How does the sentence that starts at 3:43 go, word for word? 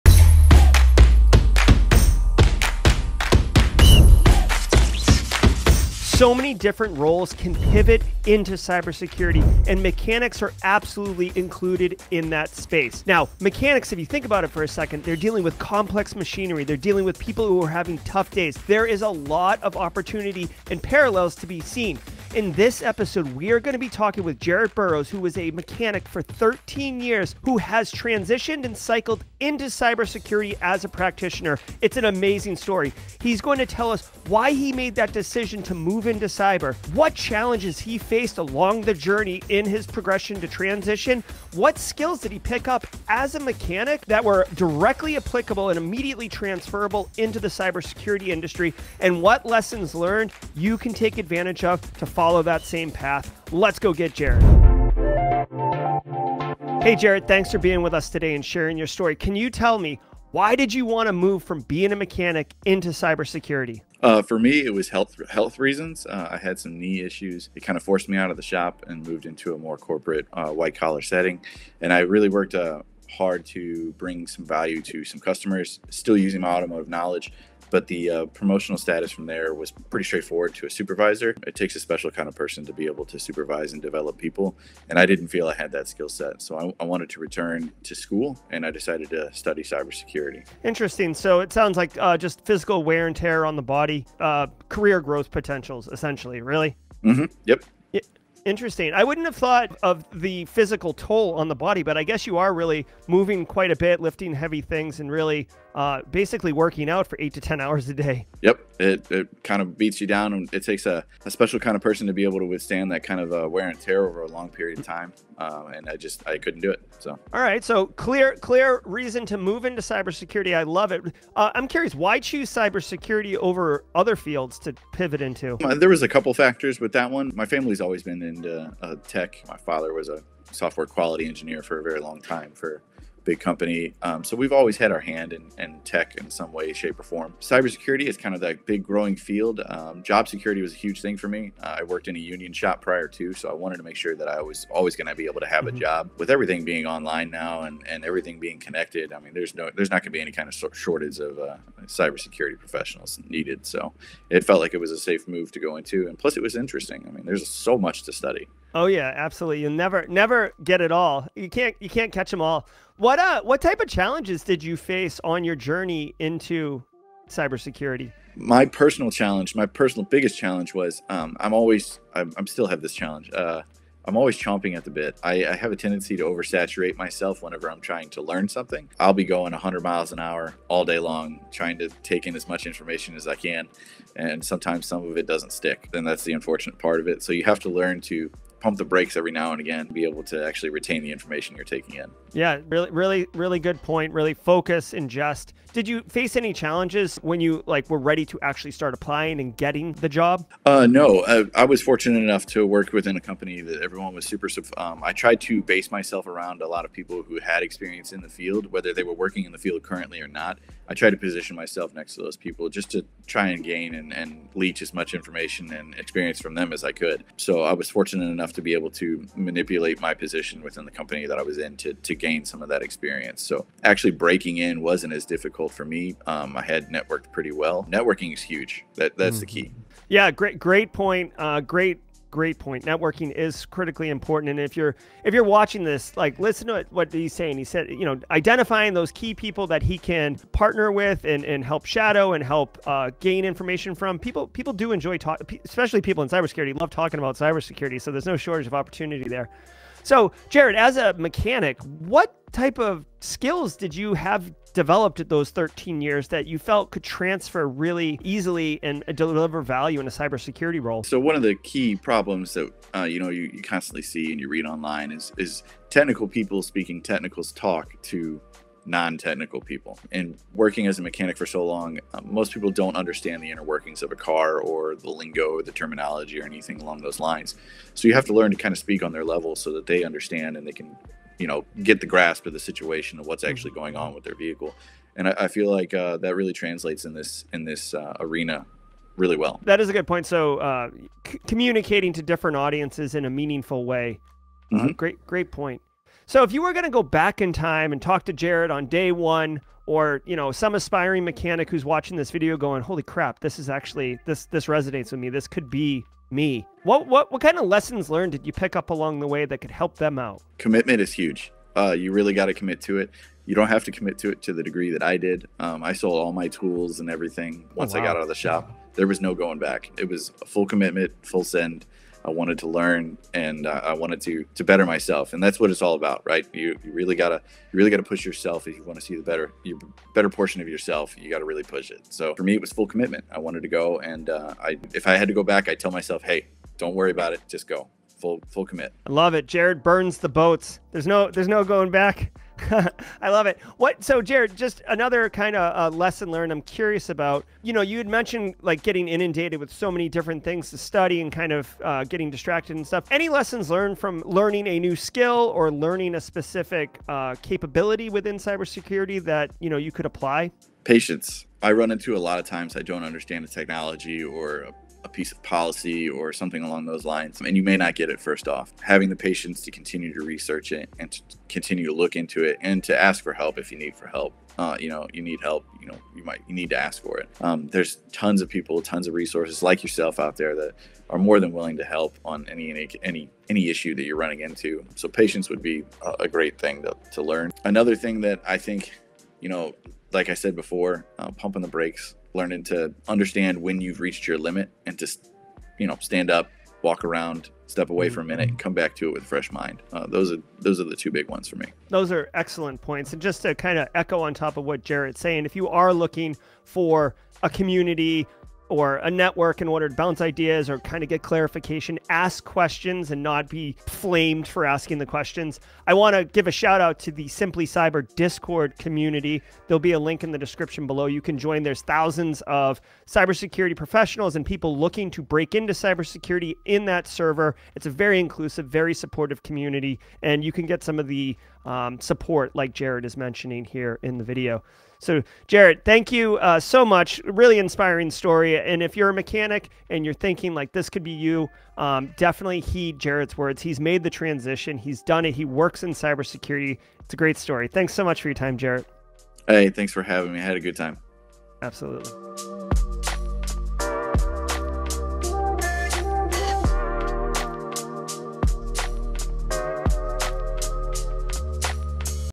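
So actually breaking in wasn't as difficult for me.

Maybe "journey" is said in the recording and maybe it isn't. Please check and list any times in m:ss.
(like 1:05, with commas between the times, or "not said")
0:38, 2:45.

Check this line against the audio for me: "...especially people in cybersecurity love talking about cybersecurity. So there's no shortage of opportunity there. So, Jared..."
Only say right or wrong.
right.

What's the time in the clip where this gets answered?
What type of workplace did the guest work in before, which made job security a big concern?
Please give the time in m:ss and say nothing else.
2:22.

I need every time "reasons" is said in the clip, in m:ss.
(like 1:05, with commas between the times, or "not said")
1:05, 1:58.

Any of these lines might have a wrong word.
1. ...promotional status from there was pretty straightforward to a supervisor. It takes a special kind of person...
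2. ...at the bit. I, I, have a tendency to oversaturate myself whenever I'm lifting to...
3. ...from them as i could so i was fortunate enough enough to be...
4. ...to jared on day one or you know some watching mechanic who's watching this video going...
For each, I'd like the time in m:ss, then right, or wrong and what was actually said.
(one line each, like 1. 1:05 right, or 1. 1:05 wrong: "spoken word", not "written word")
1. 1:18 right
2. 2:54 wrong: "trying", not "lifting"
3. 3:36 right
4. 4:58 wrong: "aspiring", not "watching".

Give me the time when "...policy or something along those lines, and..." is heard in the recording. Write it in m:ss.
6:05.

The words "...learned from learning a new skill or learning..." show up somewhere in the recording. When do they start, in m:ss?
5:53.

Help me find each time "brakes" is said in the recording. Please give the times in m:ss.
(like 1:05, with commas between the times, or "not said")
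3:08, 6:31.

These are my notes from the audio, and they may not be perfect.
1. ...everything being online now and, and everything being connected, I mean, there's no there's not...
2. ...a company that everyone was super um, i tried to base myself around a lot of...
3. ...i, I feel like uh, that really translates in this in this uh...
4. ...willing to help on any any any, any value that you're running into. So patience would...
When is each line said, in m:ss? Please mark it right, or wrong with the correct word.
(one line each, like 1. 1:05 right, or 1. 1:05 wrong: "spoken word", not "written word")
1. 2:26 right
2. 3:23 right
3. 4:45 right
4. 6:21 wrong: "issue", not "value".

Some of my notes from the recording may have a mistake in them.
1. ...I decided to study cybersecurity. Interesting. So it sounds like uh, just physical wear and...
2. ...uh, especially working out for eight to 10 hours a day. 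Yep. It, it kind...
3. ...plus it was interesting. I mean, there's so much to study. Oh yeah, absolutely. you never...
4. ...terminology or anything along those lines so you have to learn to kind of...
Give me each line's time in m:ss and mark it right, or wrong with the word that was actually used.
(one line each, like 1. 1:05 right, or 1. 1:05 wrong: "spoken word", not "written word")
1. 1:28 right
2. 1:45 wrong: "basically", not "especially"
3. 2:36 right
4. 4:35 right.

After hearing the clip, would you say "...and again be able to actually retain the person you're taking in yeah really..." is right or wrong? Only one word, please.
wrong.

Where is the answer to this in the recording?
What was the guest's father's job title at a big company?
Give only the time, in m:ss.
2:10.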